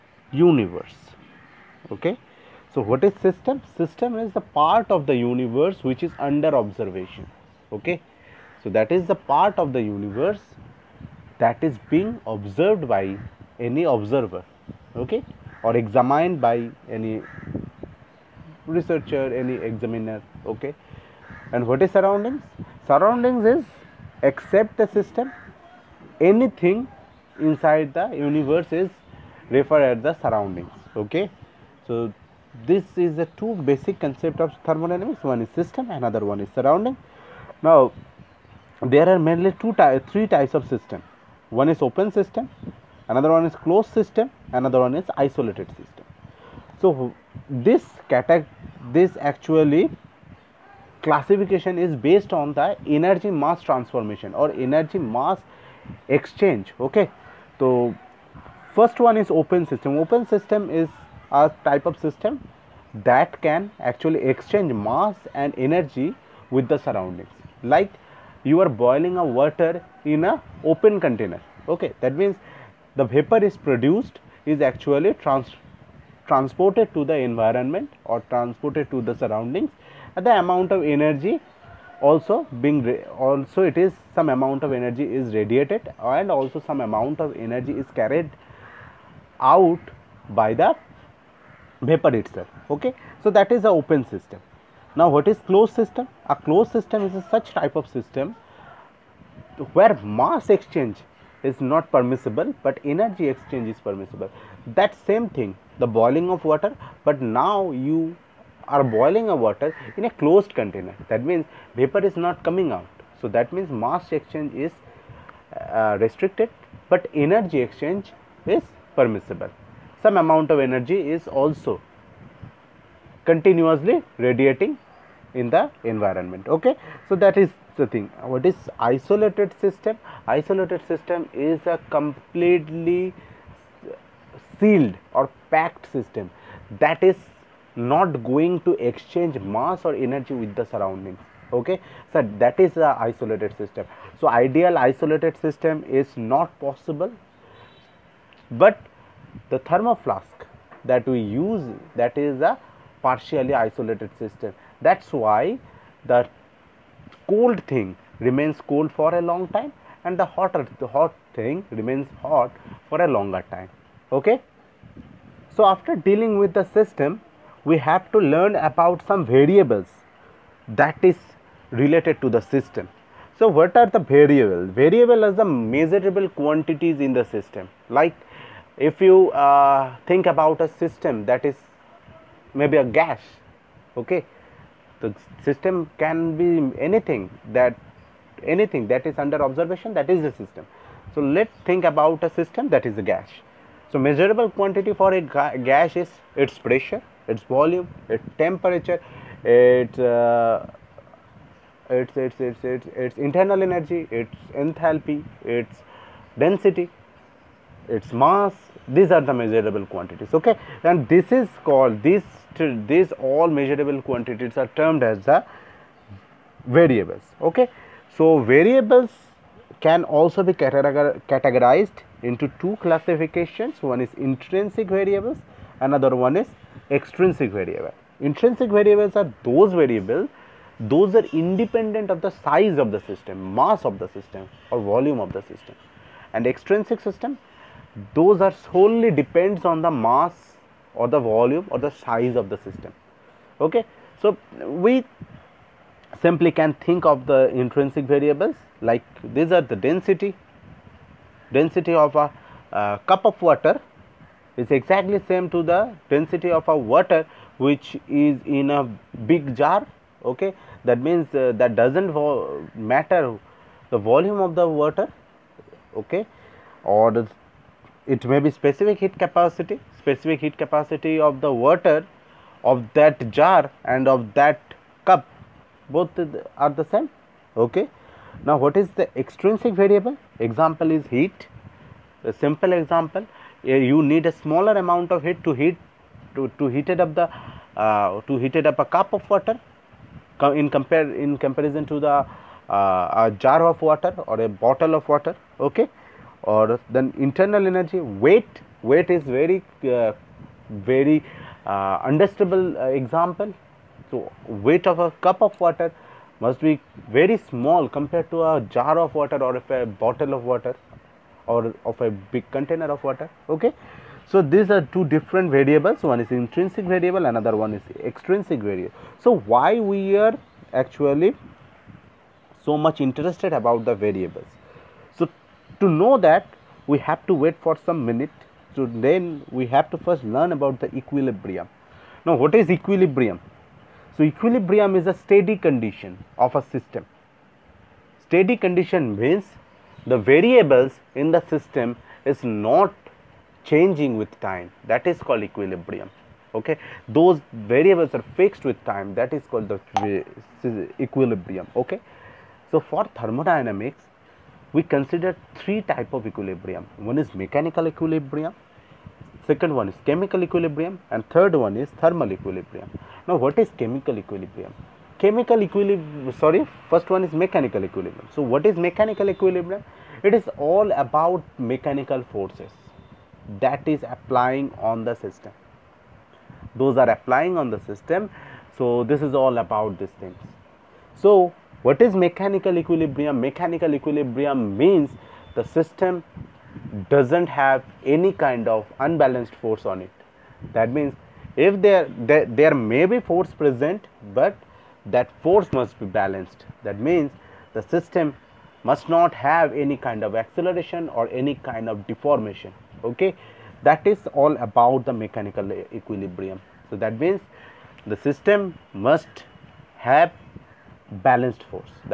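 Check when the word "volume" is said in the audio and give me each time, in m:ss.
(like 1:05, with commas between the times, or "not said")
3:17, 3:54, 4:01, 4:23.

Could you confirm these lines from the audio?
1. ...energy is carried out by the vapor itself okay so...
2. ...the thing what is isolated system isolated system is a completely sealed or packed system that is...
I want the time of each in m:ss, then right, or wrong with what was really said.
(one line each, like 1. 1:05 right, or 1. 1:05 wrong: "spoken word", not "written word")
1. 1:27 right
2. 2:07 right.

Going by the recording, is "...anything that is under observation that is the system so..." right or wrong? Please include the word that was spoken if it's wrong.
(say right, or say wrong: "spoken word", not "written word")
right.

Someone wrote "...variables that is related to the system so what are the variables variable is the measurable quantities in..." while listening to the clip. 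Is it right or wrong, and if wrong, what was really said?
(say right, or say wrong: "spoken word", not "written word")
right.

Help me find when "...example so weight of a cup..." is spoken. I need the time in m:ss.
5:02.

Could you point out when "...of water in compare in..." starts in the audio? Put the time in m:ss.
4:49.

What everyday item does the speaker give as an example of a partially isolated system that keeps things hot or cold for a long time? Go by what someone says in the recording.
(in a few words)
thermo flask.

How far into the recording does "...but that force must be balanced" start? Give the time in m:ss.
6:34.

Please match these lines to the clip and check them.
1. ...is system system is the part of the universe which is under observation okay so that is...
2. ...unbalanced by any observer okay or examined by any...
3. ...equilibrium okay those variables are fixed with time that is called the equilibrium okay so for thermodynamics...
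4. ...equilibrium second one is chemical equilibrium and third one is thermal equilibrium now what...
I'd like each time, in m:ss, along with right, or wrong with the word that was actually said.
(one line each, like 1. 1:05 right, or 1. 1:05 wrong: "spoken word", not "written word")
1. 0:03 right
2. 0:12 wrong: "observed", not "unbalanced"
3. 5:45 right
4. 5:57 right.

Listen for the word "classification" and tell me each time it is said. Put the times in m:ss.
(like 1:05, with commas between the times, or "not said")
0:51, 3:42.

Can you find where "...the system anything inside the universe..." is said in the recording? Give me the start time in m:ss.
0:24.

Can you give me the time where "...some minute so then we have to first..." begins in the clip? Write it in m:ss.
5:27.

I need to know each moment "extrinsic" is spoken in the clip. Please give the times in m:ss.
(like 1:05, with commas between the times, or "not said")
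3:46, 3:56, 4:39, 5:18.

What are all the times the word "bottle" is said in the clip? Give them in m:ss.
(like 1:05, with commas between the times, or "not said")
4:54, 5:09.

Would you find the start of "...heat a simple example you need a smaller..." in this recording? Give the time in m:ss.
4:41.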